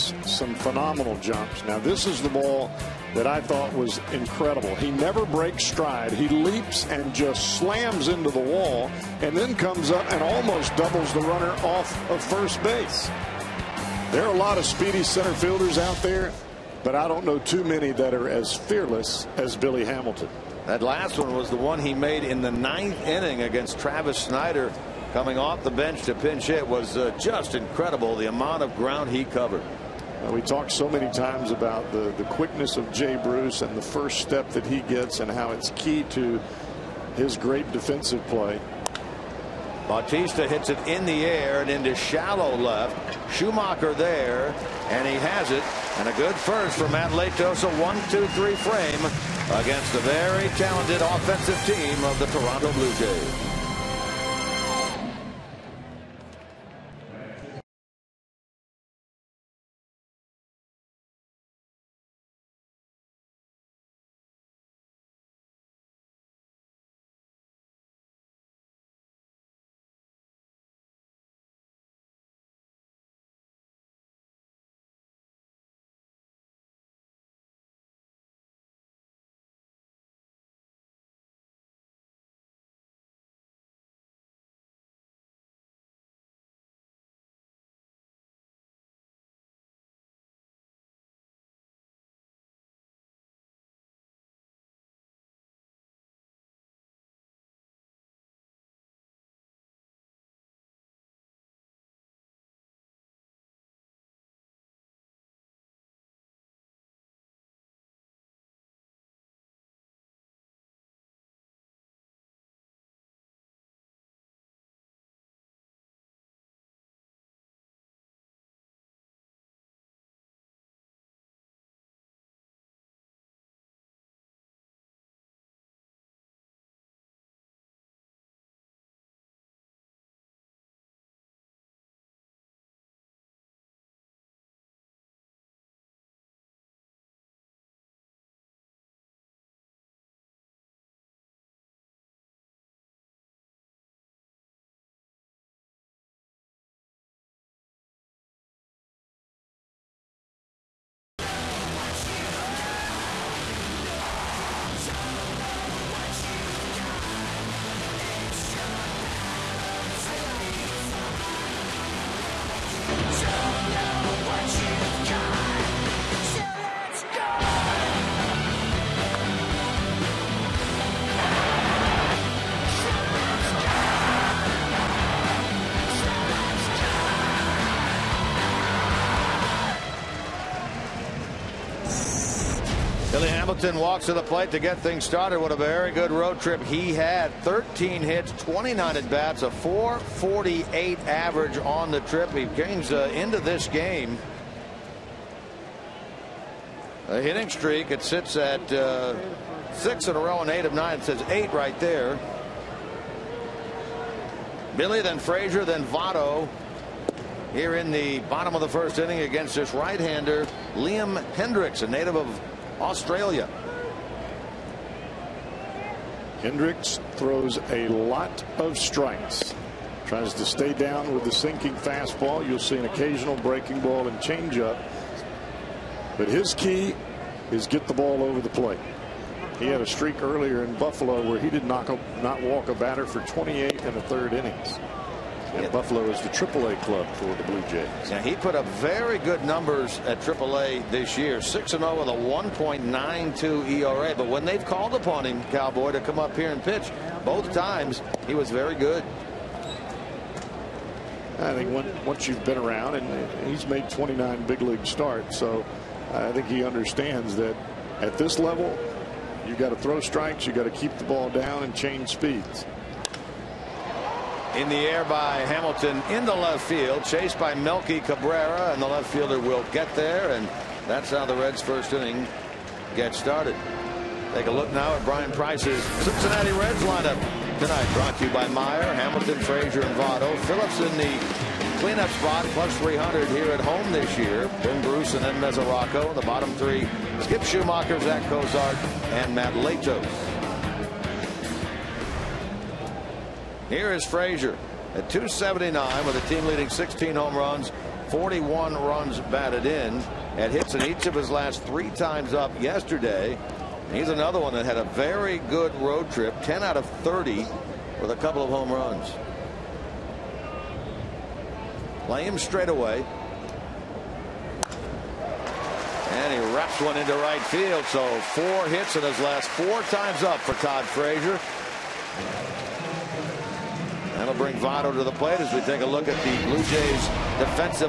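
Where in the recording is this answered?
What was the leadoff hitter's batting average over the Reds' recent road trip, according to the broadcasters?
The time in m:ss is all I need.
3:09.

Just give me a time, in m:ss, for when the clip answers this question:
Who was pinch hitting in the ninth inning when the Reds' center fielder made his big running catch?
0:23.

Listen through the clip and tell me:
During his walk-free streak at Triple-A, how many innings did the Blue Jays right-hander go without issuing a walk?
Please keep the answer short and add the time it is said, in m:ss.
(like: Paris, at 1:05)
28 1/3, at 3:53.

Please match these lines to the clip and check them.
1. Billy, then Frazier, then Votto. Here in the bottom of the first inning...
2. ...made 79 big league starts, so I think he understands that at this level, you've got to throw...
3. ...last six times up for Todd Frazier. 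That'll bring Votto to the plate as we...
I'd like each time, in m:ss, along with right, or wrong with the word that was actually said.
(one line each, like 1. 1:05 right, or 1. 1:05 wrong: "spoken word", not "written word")
1. 3:24 right
2. 4:13 wrong: "29", not "79"
3. 5:19 wrong: "four", not "six".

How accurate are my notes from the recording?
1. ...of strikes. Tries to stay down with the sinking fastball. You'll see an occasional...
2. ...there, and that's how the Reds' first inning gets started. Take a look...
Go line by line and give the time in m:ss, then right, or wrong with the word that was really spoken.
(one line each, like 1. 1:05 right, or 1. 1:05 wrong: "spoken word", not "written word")
1. 3:38 right
2. 4:29 right.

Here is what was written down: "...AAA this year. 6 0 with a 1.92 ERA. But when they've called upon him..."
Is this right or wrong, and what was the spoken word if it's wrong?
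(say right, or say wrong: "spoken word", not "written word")
right.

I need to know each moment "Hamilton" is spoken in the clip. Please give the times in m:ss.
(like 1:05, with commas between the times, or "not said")
0:19, 3:03, 4:25, 4:38.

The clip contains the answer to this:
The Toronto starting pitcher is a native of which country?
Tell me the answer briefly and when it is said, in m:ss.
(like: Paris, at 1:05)
Australia, at 3:32.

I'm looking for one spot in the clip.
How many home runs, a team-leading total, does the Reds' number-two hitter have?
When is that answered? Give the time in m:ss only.
4:56.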